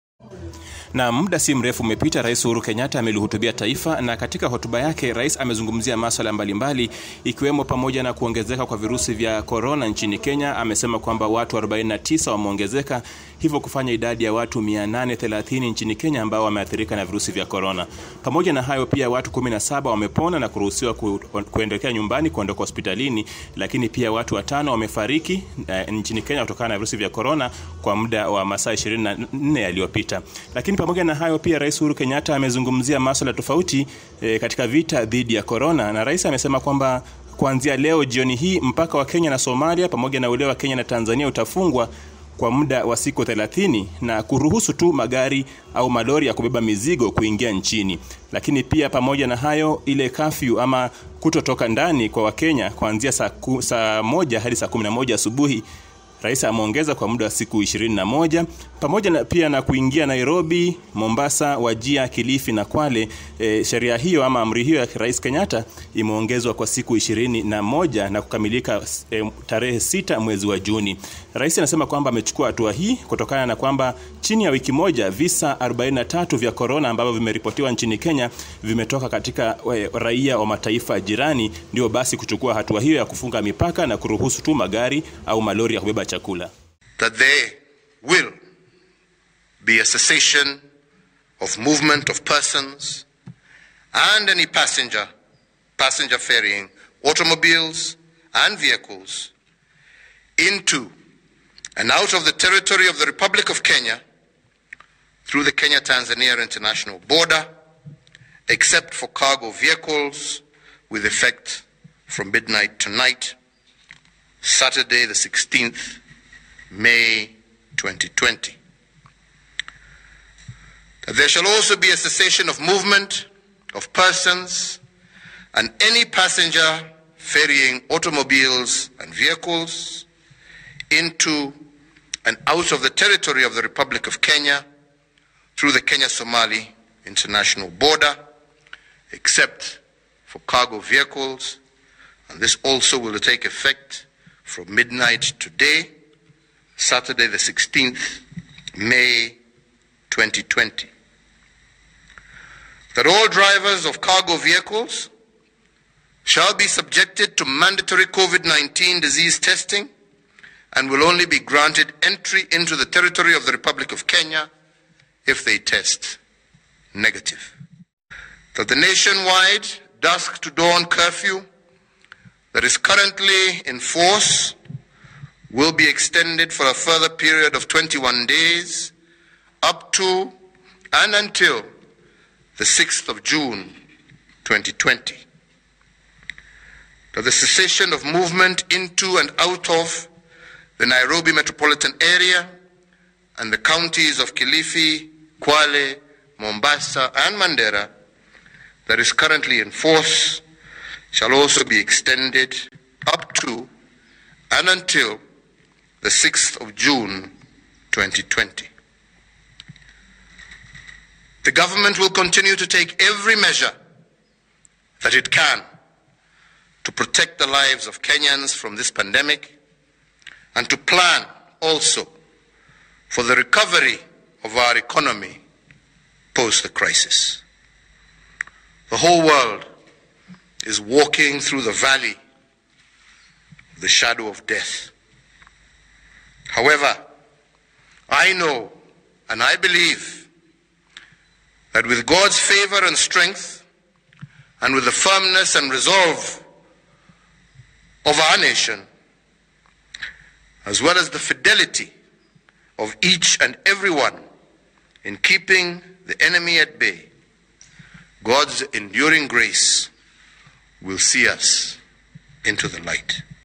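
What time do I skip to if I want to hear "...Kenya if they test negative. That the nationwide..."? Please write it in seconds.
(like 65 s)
164 s.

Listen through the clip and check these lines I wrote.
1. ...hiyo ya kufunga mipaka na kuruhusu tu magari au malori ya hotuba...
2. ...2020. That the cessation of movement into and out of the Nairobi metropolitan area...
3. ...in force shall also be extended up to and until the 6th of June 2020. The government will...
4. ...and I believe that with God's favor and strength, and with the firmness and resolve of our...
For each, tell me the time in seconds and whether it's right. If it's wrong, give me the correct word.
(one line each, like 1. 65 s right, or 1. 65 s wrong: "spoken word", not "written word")
1. 82 s wrong: "kubeba", not "hotuba"
2. 184 s right
3. 199 s right
4. 239 s right.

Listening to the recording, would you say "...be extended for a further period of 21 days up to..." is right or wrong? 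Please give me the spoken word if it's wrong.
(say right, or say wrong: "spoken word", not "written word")
right.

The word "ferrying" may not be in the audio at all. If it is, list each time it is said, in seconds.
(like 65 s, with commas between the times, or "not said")
96 s, 127 s.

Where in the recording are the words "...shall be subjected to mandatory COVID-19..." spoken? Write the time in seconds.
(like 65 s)
156 s.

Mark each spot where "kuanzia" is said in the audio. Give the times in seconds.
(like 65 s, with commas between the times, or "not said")
37 s, 52 s.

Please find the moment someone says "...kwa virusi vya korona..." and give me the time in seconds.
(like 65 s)
8 s.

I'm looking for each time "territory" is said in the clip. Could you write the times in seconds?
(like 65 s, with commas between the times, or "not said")
102 s, 132 s, 162 s.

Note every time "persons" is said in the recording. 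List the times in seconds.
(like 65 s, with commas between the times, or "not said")
92 s, 123 s.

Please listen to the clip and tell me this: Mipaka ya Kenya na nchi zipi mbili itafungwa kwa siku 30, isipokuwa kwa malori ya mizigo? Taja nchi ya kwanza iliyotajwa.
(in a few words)
Somalia.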